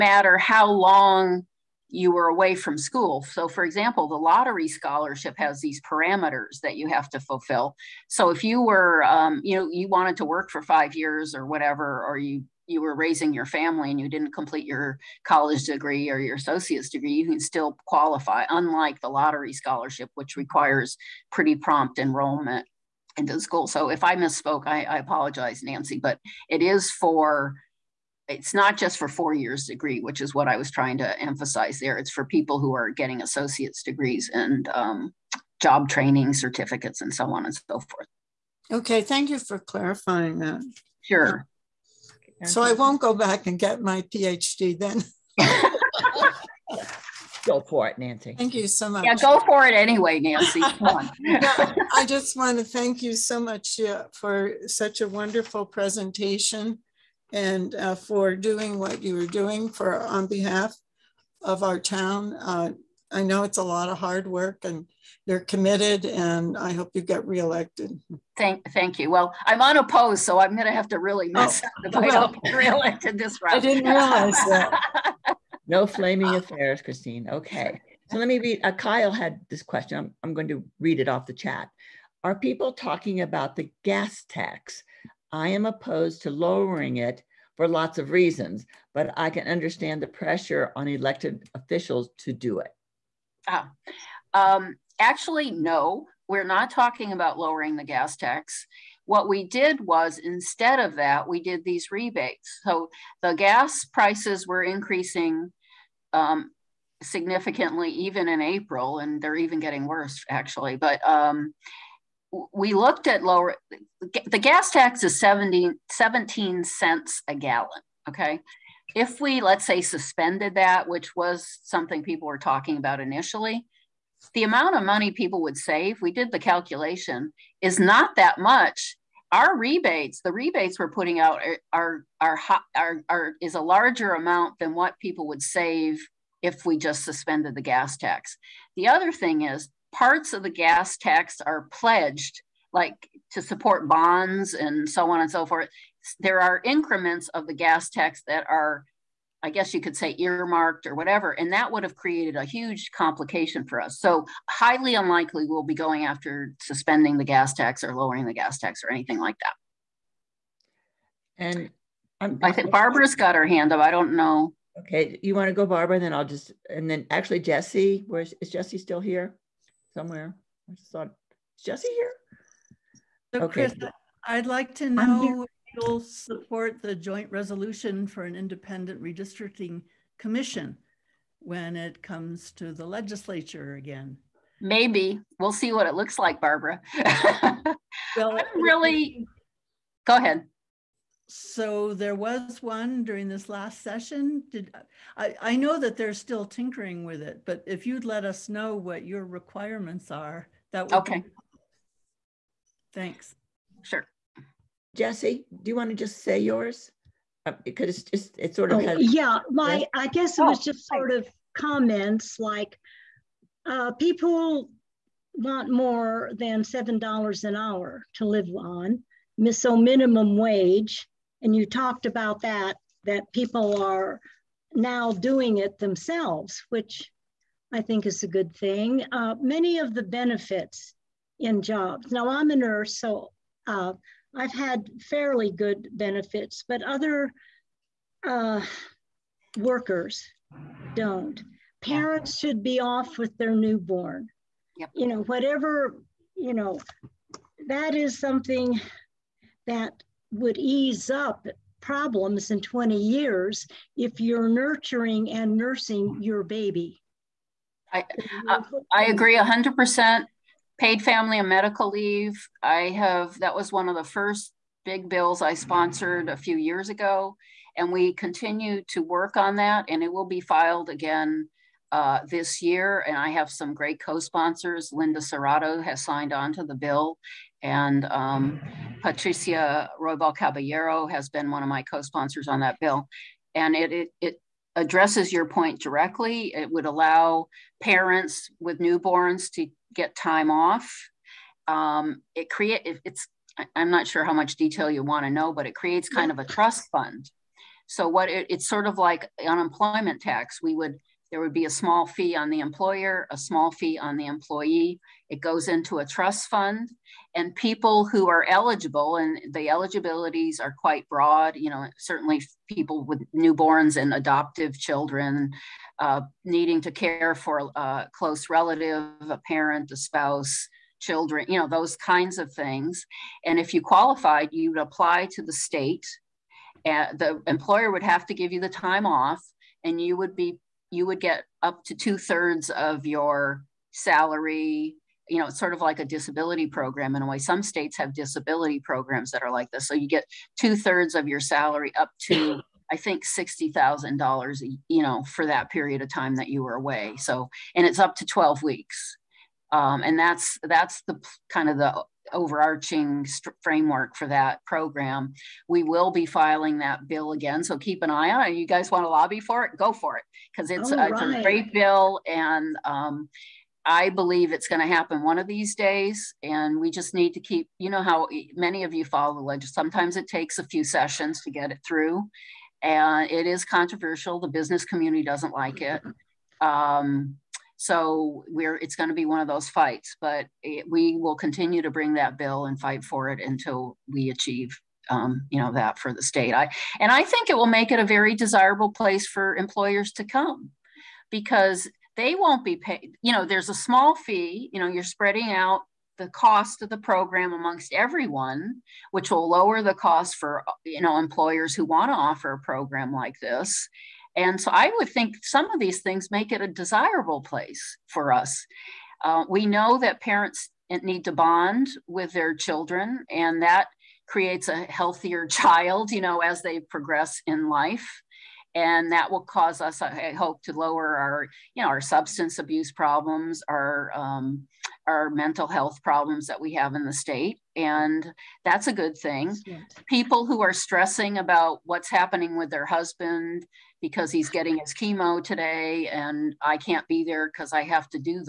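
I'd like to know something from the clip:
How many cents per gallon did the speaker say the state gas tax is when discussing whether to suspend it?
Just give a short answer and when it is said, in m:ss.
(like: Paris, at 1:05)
17 cents, at 1:55.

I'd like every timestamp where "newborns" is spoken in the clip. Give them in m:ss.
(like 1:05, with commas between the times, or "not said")
4:03, 4:48, 5:13.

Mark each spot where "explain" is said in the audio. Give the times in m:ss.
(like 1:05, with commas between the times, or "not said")
not said.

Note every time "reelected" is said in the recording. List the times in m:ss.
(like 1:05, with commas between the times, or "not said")
1:07, 1:12.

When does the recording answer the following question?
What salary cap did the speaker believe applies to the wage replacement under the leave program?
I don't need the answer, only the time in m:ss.
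5:43.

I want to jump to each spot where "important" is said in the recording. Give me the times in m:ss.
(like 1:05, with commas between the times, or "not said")
not said.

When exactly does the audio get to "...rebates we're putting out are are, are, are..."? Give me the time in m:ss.
2:10.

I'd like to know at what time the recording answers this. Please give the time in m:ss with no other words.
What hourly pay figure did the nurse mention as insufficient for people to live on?
3:36.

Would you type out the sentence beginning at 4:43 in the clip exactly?
And it, it, it addresses your point directly.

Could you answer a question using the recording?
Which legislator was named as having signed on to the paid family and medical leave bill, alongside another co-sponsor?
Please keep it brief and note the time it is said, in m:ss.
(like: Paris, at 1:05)
Linda Serrato, at 4:34.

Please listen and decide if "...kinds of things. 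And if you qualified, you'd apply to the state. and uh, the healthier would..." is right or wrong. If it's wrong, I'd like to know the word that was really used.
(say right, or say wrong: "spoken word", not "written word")
wrong: "employer", not "healthier".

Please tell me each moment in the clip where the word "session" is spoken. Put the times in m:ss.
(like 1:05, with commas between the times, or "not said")
3:13, 6:10.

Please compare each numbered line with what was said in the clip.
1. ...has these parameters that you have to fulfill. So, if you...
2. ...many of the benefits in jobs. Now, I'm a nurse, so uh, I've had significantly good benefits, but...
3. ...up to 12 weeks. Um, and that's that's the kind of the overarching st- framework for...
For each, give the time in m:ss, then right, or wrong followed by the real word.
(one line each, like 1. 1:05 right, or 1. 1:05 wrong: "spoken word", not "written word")
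1. 0:05 right
2. 3:49 wrong: "fairly", not "significantly"
3. 5:47 right.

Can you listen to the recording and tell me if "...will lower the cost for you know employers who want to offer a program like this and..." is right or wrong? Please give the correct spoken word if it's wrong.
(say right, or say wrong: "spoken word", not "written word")
right.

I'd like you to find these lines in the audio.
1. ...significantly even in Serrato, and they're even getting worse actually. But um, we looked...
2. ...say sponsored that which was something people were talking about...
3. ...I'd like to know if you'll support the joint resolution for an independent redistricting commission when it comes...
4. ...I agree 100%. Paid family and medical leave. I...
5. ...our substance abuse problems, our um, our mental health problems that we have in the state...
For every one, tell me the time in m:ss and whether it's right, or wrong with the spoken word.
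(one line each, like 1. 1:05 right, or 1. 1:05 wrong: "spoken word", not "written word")
1. 1:47 wrong: "April", not "Serrato"
2. 1:59 wrong: "suspended", not "sponsored"
3. 2:54 right
4. 4:18 right
5. 7:01 right.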